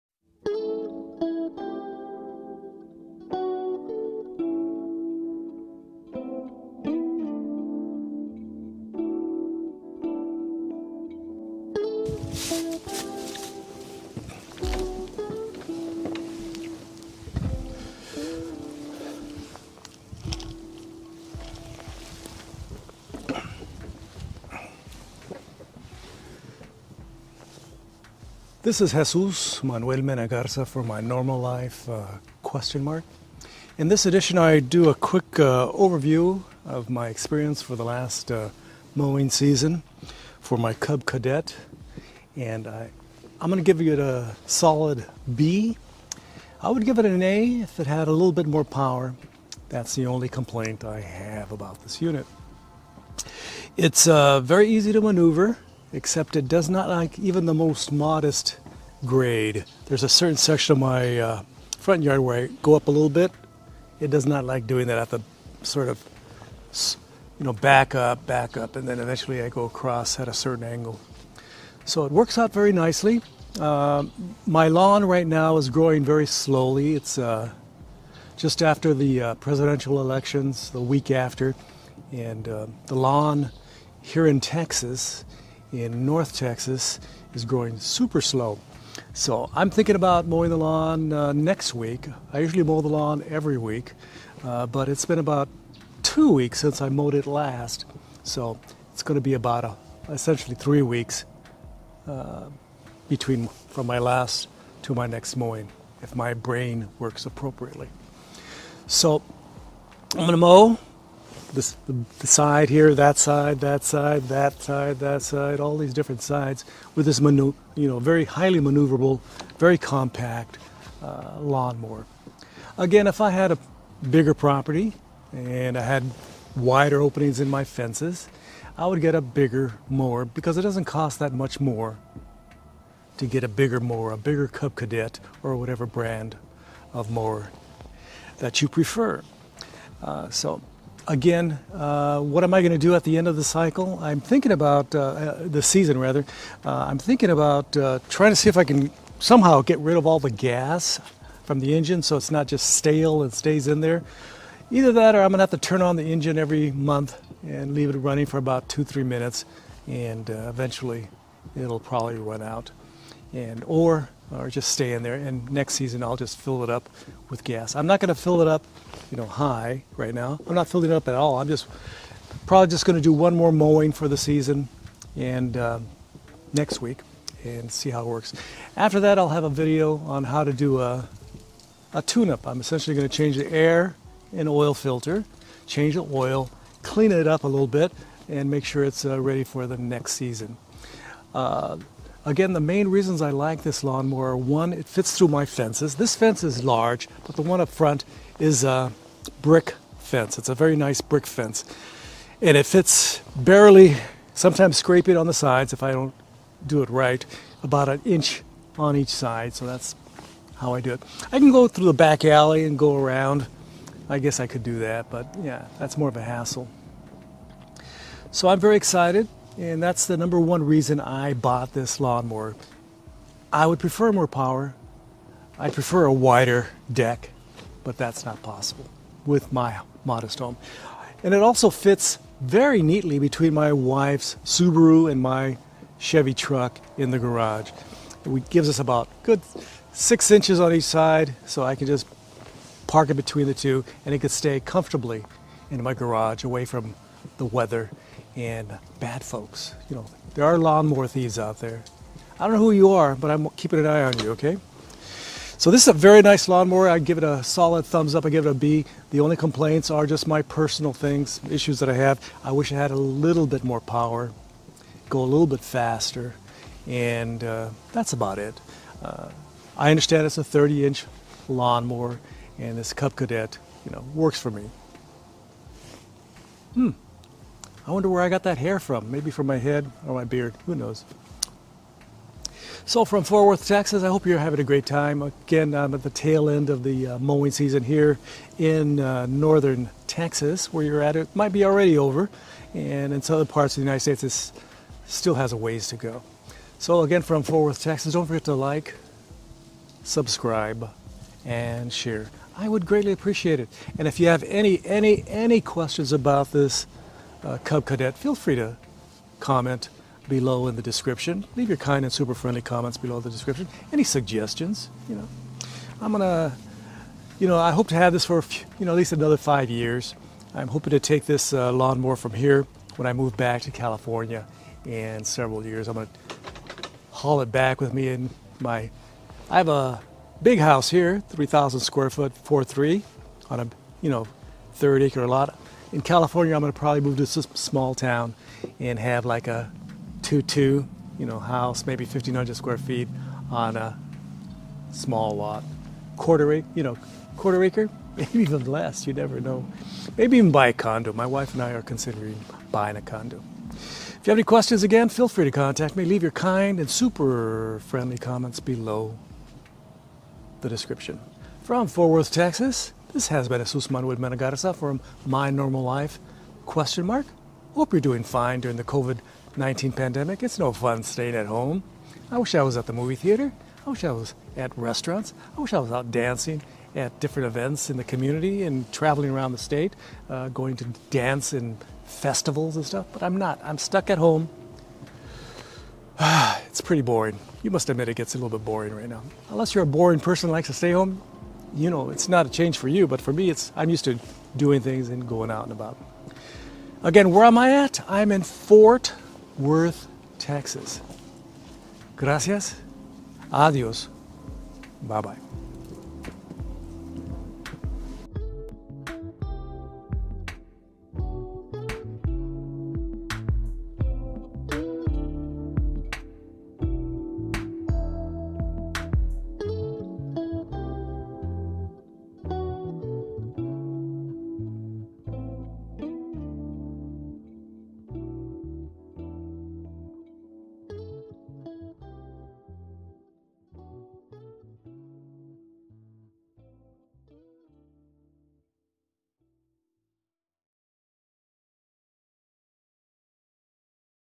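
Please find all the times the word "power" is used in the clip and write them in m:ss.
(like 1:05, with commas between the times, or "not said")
0:48, 3:44, 4:23.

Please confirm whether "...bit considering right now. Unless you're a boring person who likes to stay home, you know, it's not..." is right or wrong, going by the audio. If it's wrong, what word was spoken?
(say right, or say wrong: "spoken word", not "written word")
wrong: "boring", not "considering".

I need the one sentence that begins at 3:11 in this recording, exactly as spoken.
Uh, Again, the main reasons I like this lawnmower are one, it fits through my fences.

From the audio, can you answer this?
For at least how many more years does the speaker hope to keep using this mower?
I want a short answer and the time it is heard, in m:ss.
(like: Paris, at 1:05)
5, at 5:19.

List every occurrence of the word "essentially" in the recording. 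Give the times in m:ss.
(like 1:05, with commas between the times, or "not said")
1:40, 3:02.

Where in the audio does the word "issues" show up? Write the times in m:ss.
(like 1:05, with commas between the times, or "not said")
4:21.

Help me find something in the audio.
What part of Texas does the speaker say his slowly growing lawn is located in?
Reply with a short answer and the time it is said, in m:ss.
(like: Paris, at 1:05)
North Texas, at 1:26.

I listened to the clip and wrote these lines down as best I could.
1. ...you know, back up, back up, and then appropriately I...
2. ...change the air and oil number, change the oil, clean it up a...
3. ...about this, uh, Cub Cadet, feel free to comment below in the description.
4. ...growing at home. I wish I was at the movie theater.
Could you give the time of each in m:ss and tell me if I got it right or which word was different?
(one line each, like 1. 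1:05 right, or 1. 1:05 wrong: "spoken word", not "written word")
1. 1:07 wrong: "eventually", not "appropriately"
2. 3:03 wrong: "filter", not "number"
3. 5:06 right
4. 6:11 wrong: "staying", not "growing".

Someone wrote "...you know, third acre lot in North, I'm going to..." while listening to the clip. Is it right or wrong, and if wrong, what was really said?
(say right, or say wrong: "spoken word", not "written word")
wrong: "California", not "North".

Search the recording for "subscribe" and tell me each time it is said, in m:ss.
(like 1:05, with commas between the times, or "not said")
5:00.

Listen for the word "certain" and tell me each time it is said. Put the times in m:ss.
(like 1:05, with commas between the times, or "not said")
1:00, 1:10.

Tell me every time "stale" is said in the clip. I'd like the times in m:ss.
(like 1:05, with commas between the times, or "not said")
2:32.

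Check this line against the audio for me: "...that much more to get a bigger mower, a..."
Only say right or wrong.
right.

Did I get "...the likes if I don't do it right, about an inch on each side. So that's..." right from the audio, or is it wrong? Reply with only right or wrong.
wrong.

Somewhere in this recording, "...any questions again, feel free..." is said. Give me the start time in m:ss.
5:54.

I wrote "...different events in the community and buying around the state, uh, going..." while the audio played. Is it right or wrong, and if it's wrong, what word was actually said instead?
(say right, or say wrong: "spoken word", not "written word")
wrong: "traveling", not "buying".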